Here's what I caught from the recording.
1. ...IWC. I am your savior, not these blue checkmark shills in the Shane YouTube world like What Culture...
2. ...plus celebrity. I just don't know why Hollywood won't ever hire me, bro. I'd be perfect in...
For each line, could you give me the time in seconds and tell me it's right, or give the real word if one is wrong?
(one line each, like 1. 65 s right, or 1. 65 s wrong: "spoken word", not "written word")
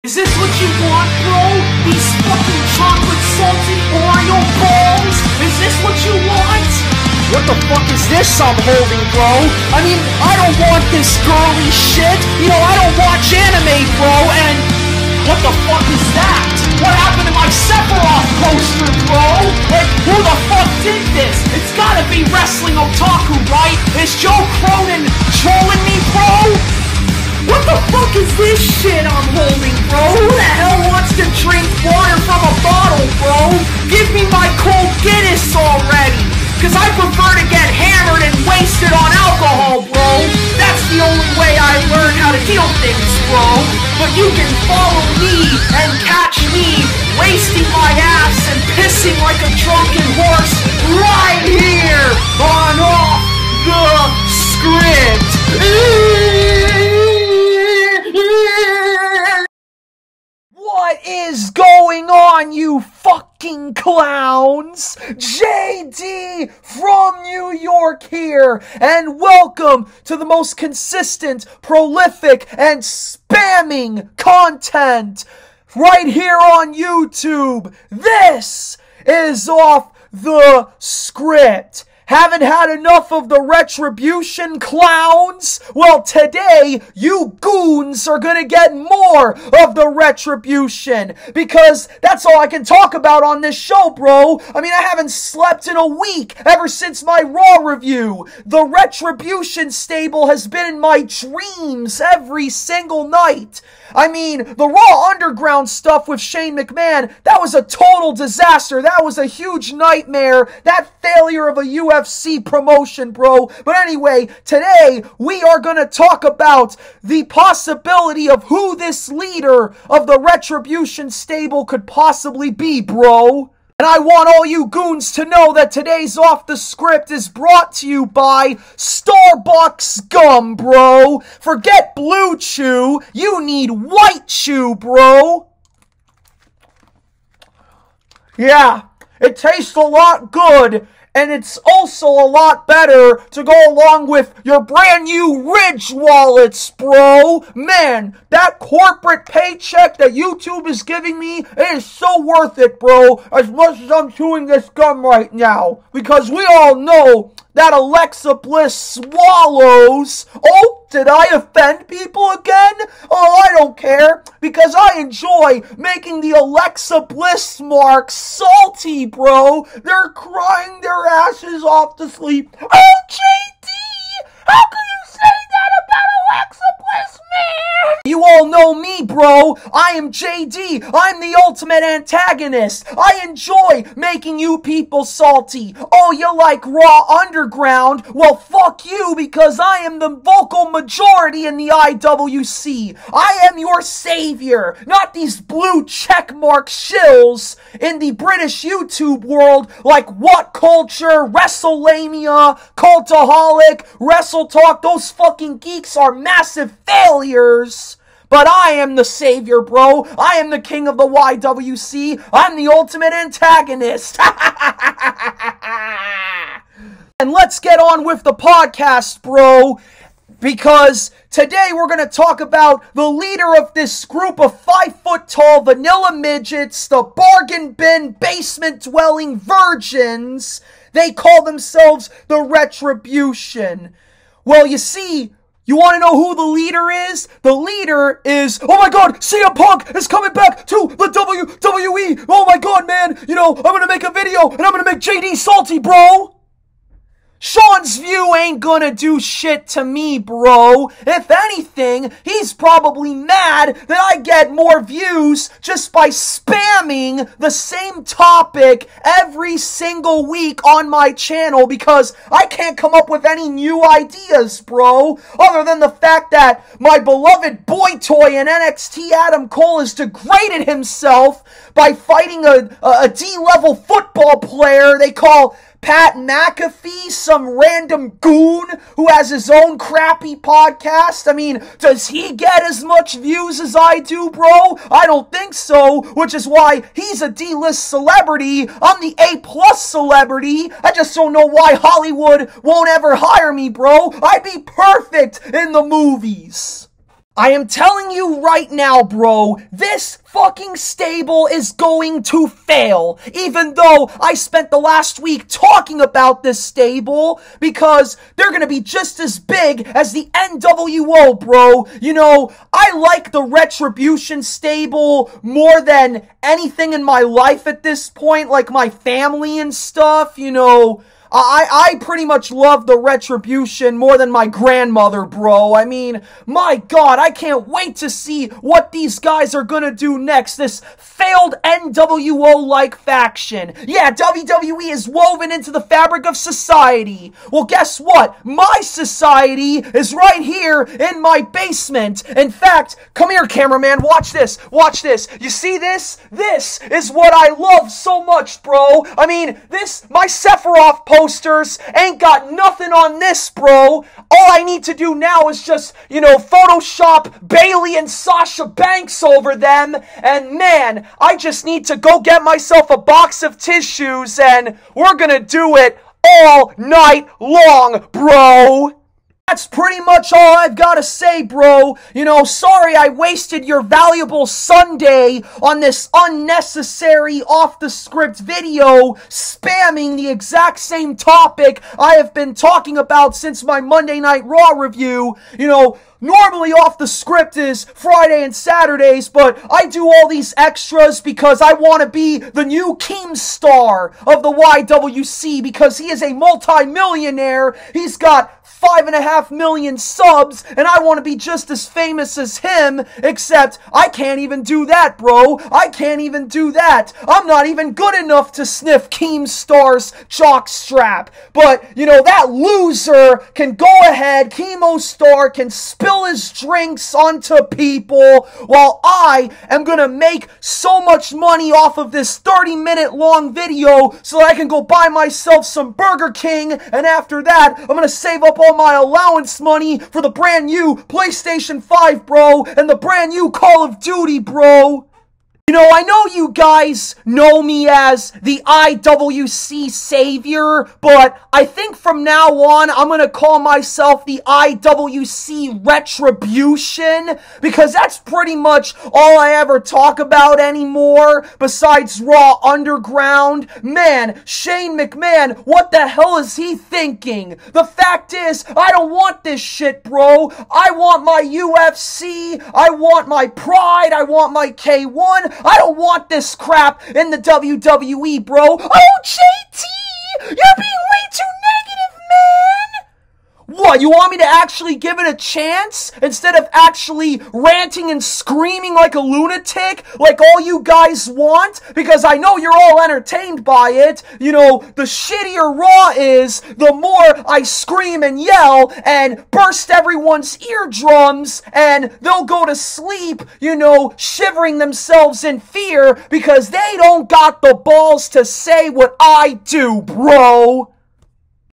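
1. 191 s wrong: "British", not "Shane"
2. 289 s right.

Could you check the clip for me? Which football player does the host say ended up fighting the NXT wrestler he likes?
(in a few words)
Pat McAfee.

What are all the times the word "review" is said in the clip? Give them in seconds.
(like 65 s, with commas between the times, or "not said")
97 s, 384 s.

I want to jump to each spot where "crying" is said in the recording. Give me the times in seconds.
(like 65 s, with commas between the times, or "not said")
170 s.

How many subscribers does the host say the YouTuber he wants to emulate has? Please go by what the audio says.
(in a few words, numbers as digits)
5.5 million.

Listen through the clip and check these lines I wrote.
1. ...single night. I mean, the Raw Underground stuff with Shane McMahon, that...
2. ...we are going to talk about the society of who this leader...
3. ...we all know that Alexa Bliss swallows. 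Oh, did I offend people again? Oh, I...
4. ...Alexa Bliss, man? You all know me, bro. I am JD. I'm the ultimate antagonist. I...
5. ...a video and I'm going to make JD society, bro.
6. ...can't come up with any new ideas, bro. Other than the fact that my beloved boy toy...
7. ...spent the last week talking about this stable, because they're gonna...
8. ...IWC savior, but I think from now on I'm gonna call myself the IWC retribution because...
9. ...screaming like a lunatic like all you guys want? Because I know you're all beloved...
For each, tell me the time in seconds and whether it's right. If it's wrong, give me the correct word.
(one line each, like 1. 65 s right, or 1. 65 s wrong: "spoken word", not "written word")
1. 102 s right
2. 115 s wrong: "possibility", not "society"
3. 156 s right
4. 176 s right
5. 244 s wrong: "salty", not "society"
6. 262 s right
7. 304 s right
8. 438 s right
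9. 478 s wrong: "entertained", not "beloved".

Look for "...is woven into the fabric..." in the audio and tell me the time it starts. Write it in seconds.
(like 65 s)
334 s.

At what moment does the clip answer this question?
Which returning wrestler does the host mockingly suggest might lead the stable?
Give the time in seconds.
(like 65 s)
239 s.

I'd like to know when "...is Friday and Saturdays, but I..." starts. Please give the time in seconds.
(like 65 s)
387 s.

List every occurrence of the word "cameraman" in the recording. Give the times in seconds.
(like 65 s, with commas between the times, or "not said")
343 s.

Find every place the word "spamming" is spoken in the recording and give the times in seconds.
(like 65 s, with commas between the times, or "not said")
72 s, 256 s, 379 s.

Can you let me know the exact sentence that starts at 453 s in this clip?
Man, Shane McMahon, what the hell is he thinking?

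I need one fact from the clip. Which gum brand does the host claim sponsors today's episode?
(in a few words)
Starbucks Gum.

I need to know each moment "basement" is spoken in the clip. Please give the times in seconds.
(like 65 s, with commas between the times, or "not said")
228 s, 341 s.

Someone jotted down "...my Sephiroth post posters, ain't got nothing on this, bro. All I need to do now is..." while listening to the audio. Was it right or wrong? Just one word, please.
right.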